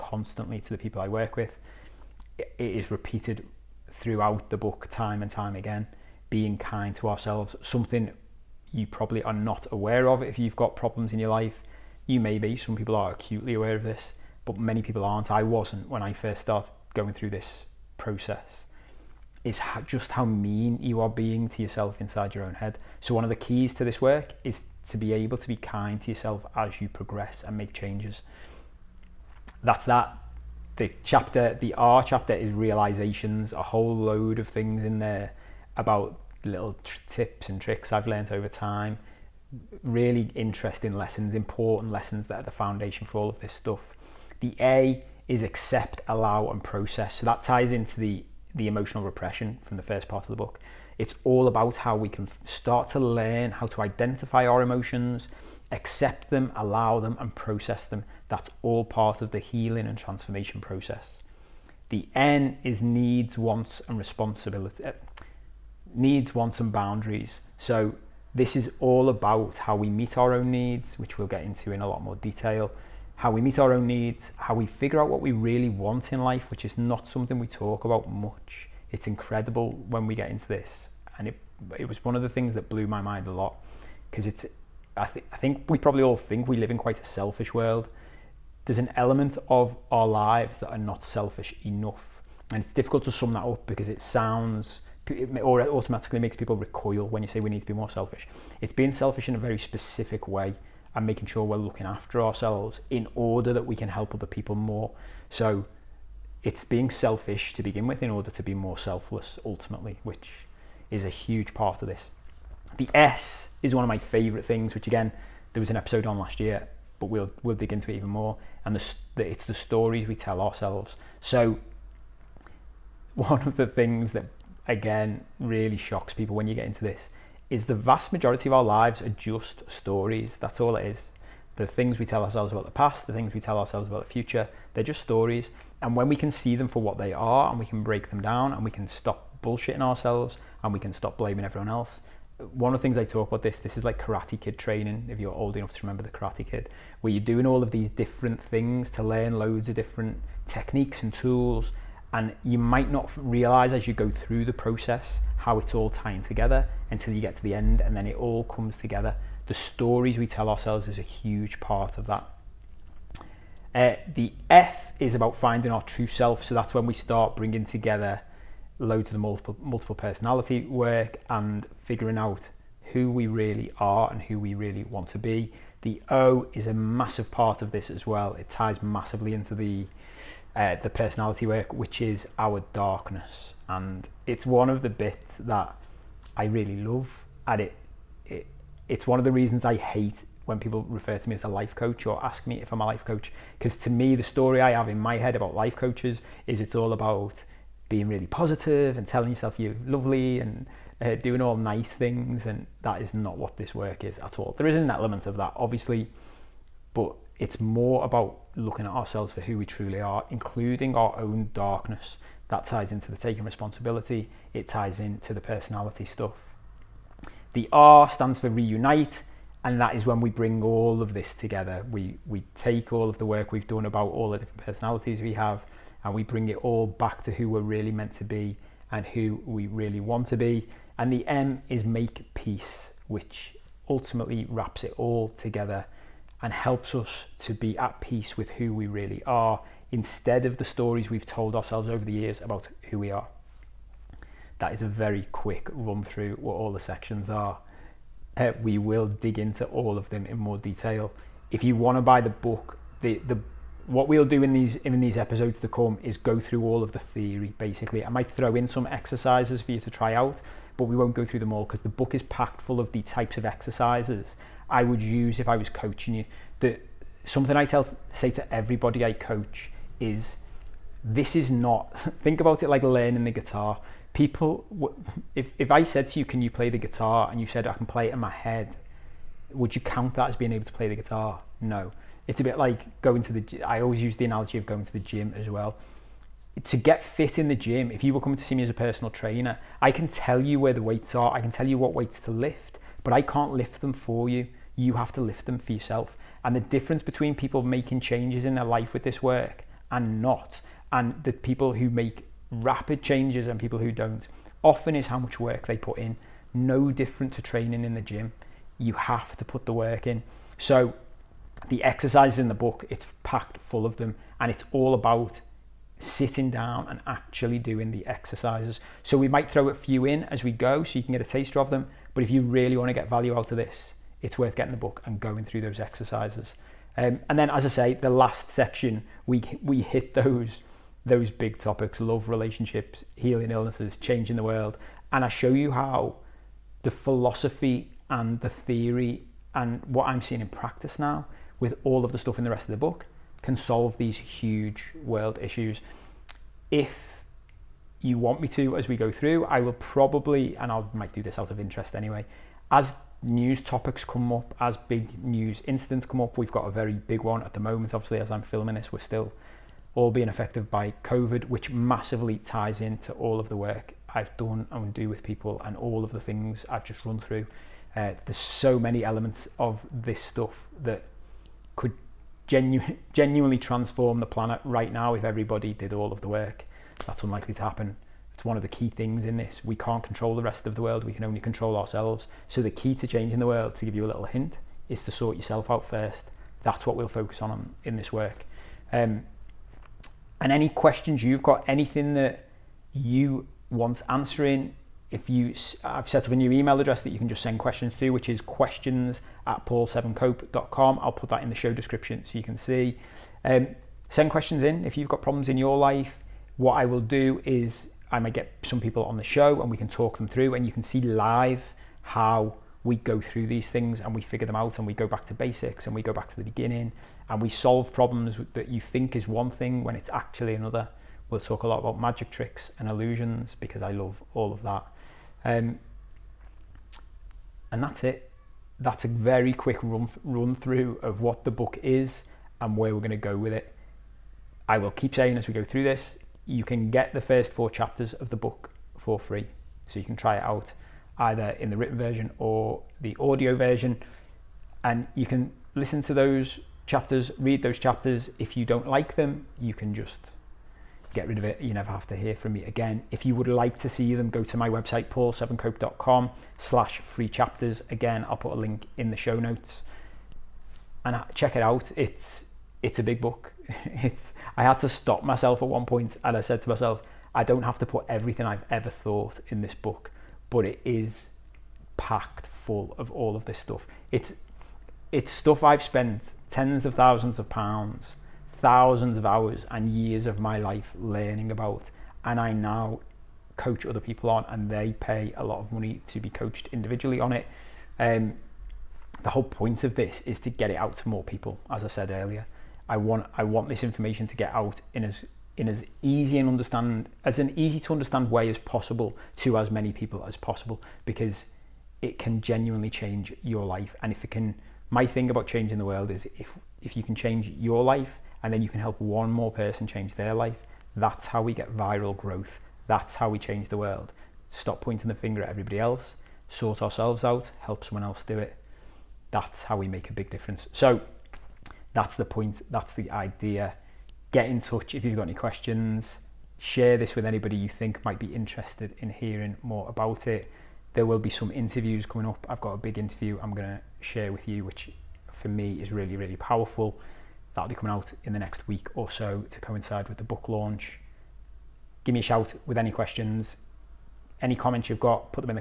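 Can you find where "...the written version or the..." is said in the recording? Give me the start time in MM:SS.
07:21.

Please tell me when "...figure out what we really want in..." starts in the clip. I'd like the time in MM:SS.
01:14.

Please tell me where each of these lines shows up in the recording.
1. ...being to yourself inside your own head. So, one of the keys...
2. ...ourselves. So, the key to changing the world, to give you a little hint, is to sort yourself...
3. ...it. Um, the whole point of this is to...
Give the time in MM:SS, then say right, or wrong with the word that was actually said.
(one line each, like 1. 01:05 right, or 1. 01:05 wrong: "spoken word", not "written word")
1. 00:21 right
2. 06:21 right
3. 08:07 right.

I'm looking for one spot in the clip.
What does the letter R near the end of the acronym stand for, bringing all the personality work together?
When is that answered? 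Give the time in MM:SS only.
03:38.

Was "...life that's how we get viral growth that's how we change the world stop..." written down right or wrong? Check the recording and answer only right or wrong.
right.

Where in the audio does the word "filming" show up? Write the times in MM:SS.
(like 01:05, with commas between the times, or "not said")
05:58.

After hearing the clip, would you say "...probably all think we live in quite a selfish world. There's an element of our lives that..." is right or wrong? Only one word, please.
right.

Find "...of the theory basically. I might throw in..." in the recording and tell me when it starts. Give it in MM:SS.
04:16.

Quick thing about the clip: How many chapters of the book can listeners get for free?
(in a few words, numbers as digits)
4.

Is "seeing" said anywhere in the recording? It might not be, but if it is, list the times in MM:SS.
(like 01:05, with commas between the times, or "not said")
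05:40.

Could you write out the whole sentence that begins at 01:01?
The N is needs, wants, and responsibility.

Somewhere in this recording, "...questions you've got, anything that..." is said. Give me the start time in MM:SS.
06:30.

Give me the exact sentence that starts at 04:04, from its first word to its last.
That is a very quick run through what all the sections are.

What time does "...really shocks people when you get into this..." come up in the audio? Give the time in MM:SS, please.
02:05.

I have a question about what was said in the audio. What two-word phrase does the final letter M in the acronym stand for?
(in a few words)
Make peace.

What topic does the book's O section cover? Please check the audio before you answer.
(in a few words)
Our darkness.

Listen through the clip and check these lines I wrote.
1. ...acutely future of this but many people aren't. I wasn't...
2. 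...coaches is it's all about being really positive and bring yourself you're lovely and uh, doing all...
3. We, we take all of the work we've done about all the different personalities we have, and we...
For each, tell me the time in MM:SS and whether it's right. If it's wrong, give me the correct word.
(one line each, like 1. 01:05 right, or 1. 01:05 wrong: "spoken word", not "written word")
1. 00:13 wrong: "aware", not "future"
2. 03:15 wrong: "telling", not "bring"
3. 03:41 right.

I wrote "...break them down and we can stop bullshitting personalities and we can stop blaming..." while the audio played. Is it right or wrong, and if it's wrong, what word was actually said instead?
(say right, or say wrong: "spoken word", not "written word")
wrong: "ourselves", not "personalities".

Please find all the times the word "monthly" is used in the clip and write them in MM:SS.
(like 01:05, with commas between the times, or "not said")
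not said.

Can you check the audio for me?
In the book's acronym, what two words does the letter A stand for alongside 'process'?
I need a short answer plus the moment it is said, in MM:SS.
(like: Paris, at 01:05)
Accept, allow, at 00:45.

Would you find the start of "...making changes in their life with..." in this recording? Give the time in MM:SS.
04:57.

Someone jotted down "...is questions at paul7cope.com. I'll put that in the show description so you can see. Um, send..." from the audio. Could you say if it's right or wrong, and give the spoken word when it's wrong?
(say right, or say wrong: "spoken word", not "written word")
right.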